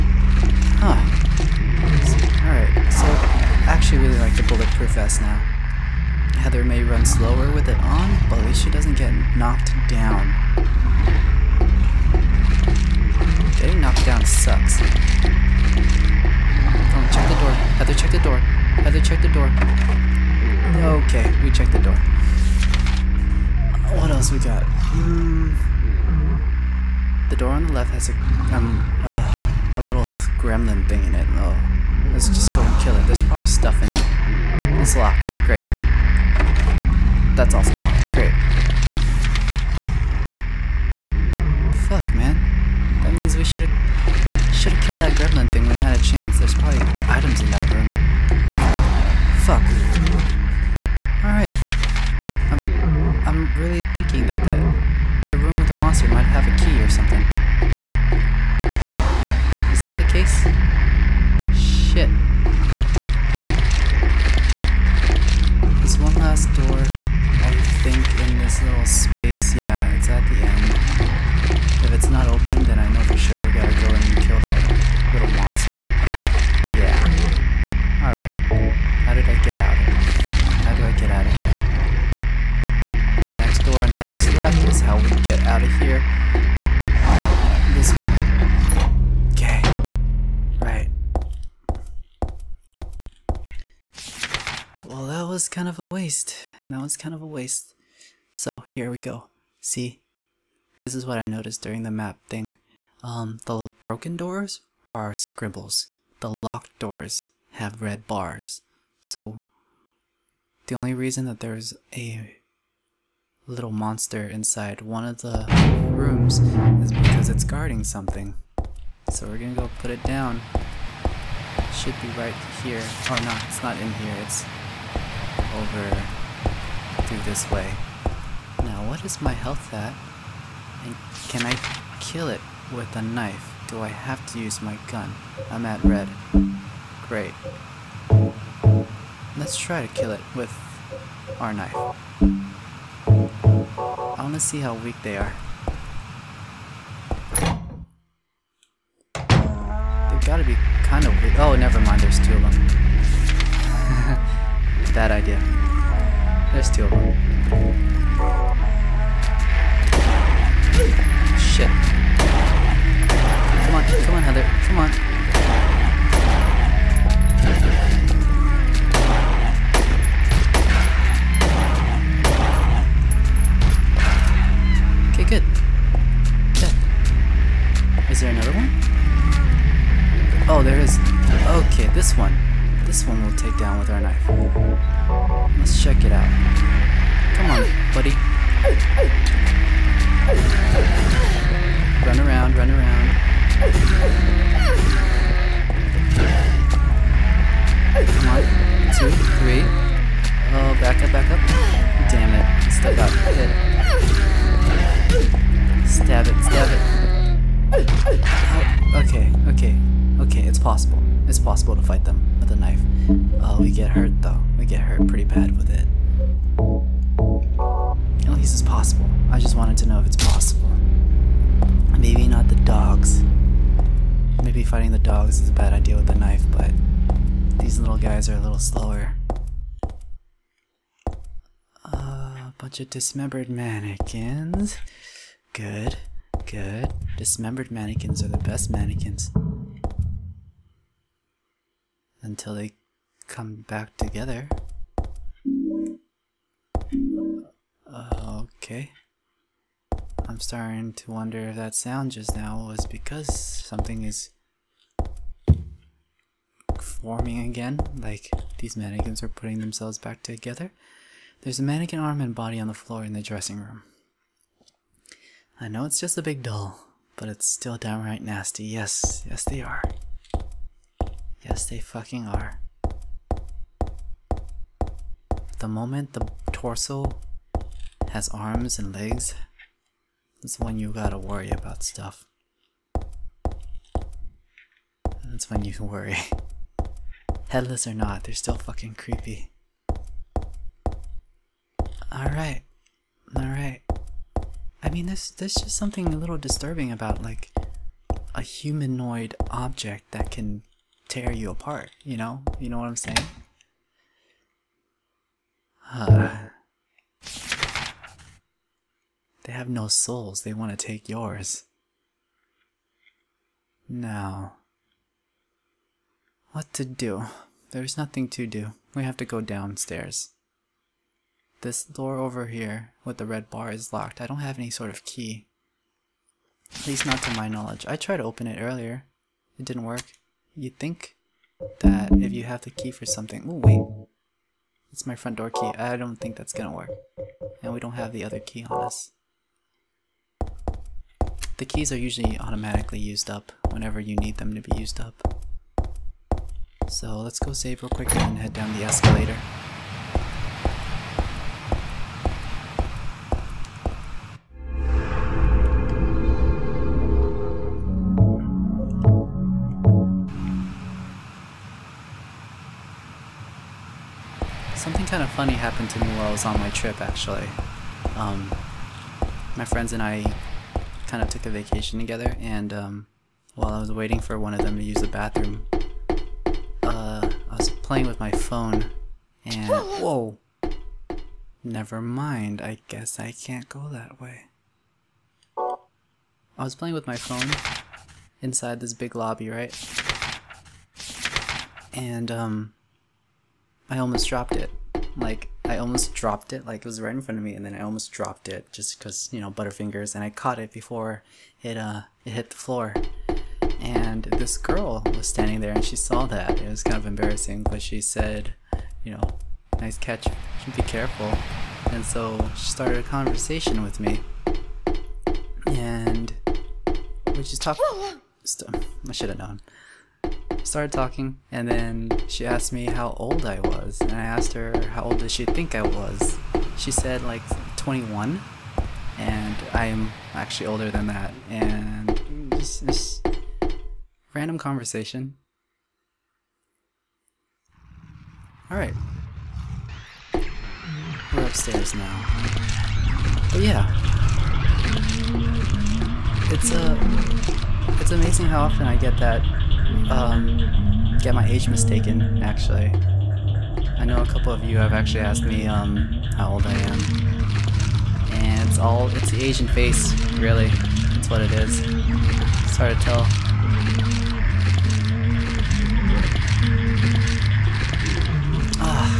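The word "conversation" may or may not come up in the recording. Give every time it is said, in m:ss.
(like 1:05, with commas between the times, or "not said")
6:53, 7:14.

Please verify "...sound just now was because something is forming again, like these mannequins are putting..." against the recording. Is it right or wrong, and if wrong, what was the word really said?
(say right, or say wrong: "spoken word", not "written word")
right.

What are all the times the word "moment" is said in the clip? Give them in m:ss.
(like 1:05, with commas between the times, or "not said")
4:35.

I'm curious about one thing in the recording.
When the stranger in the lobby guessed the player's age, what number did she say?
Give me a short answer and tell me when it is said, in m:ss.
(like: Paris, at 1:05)
21, at 7:07.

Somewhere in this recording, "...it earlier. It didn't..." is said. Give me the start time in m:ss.
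5:28.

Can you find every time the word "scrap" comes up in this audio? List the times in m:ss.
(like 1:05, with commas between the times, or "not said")
not said.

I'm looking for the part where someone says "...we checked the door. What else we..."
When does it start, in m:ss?
0:21.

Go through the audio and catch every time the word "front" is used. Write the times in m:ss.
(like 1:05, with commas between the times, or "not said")
5:35, 6:37.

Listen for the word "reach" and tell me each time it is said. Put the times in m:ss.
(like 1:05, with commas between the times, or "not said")
not said.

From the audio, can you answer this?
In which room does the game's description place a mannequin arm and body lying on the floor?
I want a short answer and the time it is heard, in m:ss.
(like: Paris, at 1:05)
Dressing room, at 4:23.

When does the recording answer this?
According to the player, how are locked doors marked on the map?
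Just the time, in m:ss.
1:47.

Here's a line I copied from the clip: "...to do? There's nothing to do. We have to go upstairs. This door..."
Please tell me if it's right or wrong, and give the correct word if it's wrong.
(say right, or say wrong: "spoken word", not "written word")
wrong: "downstairs", not "upstairs".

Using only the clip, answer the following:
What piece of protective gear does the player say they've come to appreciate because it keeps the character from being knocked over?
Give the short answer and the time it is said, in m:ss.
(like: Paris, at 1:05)
Bulletproof vest, at 0:04.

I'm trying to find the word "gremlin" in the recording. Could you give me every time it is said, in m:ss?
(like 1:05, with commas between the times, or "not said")
0:30, 0:45.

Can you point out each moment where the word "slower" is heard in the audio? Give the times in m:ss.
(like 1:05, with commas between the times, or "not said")
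0:07, 3:48.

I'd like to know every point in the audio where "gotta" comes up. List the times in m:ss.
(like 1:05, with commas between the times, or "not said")
1:13, 4:40.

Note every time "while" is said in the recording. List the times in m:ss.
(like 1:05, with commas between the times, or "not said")
6:06, 6:13.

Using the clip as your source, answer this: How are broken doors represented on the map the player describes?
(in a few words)
Scribbles.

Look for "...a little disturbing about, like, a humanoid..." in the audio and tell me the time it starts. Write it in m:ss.
4:56.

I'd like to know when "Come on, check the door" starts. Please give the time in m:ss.
0:14.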